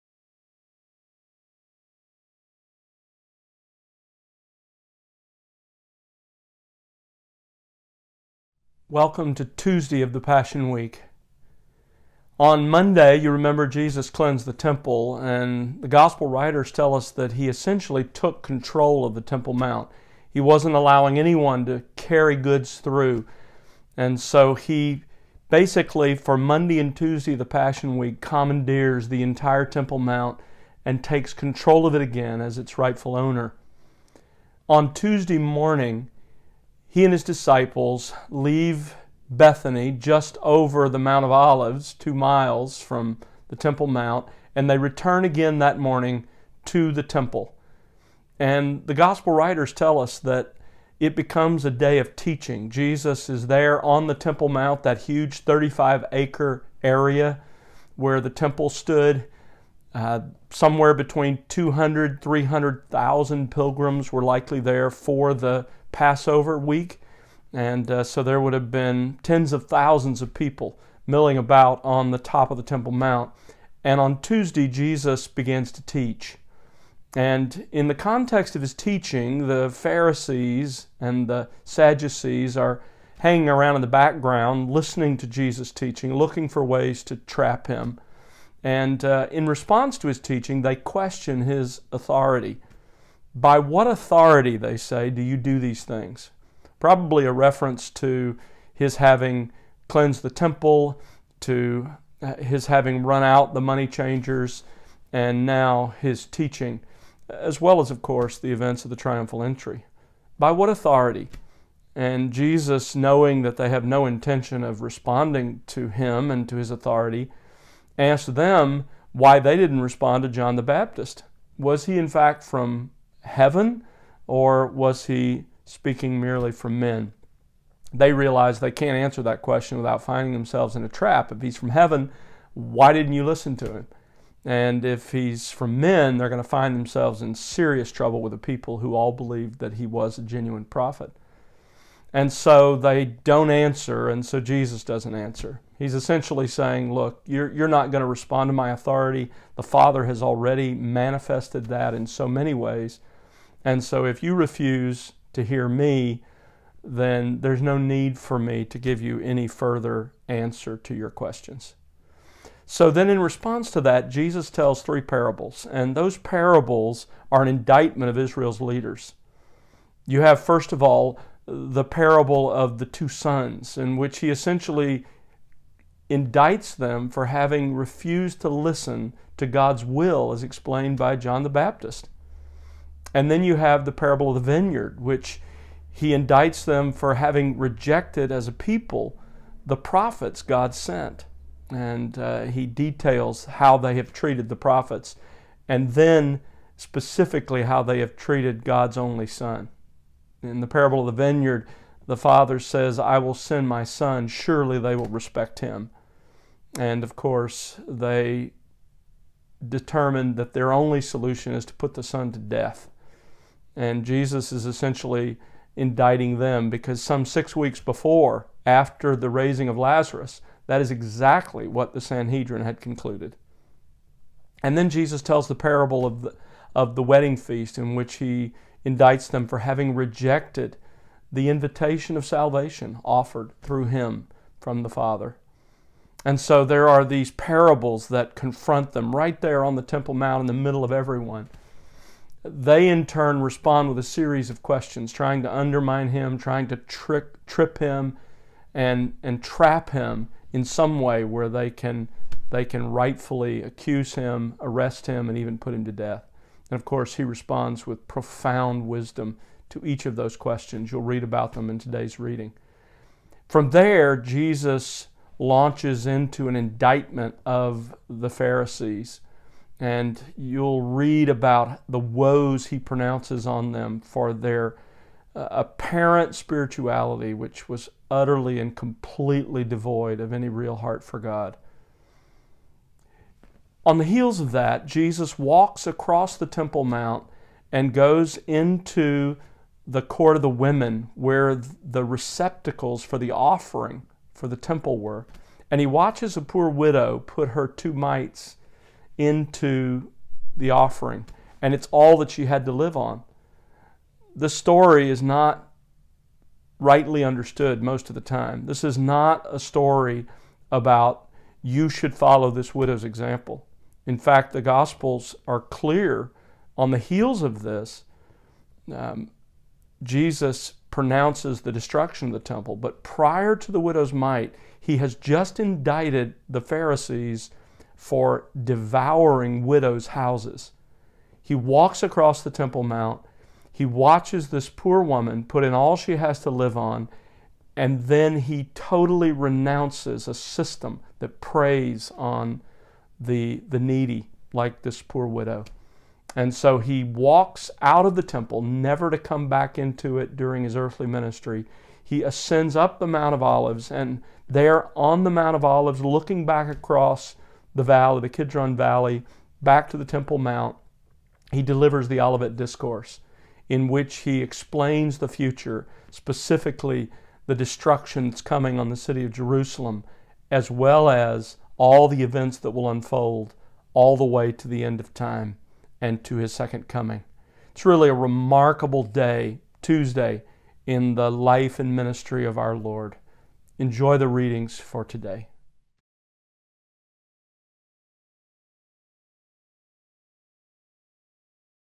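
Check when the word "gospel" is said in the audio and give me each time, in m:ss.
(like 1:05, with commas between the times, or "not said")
0:15, 0:48, 5:14.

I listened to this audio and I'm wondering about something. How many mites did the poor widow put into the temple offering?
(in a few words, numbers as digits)
2.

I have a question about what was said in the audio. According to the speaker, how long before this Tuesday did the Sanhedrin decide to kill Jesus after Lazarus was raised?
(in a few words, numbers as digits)
six weeks.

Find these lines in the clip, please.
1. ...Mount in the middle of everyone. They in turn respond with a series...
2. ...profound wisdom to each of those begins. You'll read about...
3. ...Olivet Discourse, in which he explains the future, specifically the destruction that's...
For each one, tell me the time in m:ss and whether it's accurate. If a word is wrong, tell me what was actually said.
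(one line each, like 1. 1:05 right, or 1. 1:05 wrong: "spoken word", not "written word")
1. 4:00 right
2. 4:18 wrong: "questions", not "begins"
3. 6:02 right.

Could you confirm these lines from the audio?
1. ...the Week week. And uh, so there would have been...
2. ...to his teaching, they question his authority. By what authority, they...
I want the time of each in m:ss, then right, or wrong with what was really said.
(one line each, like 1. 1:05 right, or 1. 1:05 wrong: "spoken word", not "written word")
1. 1:05 wrong: "Passover", not "Week"
2. 1:29 right.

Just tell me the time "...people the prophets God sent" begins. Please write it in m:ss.
3:08.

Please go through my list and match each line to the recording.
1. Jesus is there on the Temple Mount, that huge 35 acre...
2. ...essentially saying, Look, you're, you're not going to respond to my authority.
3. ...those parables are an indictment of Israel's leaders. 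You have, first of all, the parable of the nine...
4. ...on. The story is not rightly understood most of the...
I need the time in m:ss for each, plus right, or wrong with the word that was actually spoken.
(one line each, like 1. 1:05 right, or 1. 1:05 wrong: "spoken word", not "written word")
1. 0:52 right
2. 2:25 right
3. 2:45 wrong: "two", not "nine"
4. 5:02 right.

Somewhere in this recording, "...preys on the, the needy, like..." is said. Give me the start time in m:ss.
5:41.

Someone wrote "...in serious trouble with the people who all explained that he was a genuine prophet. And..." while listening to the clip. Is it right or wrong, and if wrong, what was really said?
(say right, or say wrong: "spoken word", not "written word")
wrong: "believed", not "explained".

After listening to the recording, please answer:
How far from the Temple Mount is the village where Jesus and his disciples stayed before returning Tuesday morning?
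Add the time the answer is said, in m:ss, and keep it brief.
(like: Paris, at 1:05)
2 miles, at 0:41.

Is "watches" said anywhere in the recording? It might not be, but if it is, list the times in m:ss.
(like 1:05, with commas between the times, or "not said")
4:55, 5:33.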